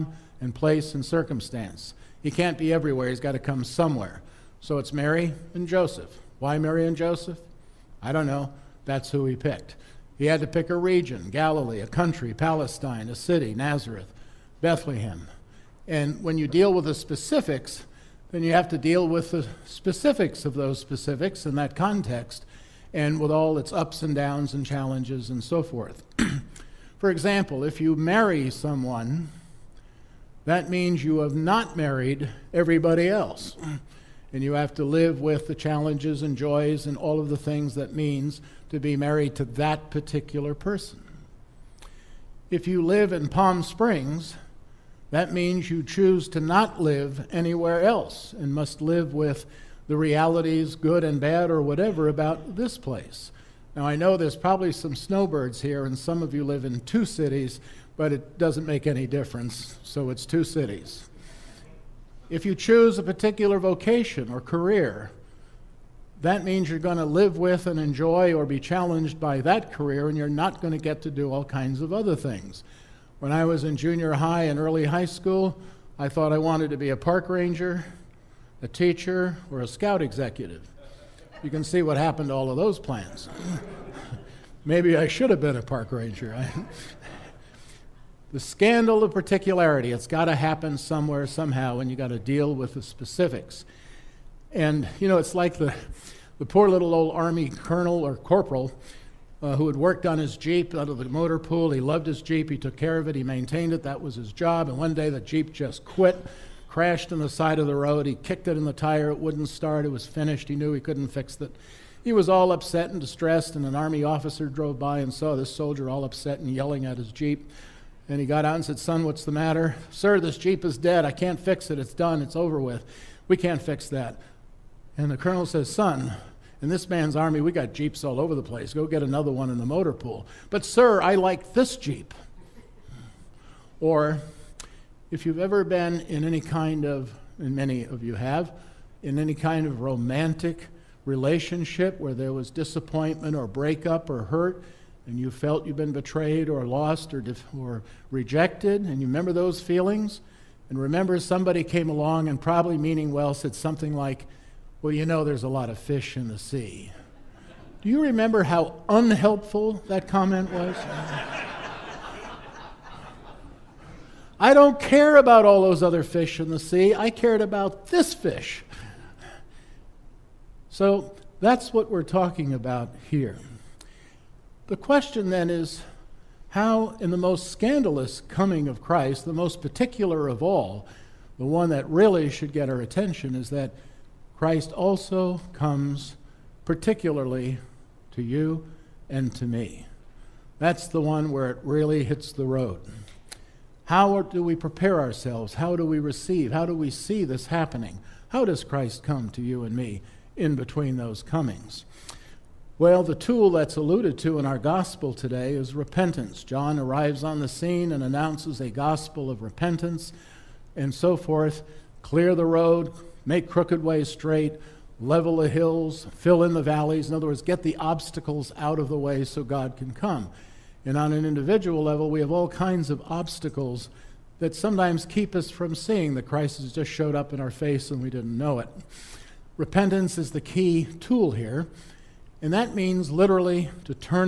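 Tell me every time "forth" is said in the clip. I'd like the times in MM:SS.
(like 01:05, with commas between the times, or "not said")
00:25, 03:31.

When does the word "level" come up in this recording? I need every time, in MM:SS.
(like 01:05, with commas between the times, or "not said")
03:34, 03:41.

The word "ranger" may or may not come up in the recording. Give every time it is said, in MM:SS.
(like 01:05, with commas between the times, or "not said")
01:17, 01:25.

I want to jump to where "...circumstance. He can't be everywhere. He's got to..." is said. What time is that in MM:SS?
00:01.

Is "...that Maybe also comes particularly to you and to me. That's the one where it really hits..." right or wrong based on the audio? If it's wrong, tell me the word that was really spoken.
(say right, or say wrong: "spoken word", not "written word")
wrong: "Christ", not "Maybe".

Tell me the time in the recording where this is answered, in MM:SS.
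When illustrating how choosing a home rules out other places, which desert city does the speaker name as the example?
00:43.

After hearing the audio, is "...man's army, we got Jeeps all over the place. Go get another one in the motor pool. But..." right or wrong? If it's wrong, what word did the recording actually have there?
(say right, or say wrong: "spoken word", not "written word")
right.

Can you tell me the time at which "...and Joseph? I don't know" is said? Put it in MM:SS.
00:06.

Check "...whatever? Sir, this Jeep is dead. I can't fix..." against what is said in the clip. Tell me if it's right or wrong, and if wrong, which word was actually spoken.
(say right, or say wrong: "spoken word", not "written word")
wrong: "matter", not "whatever".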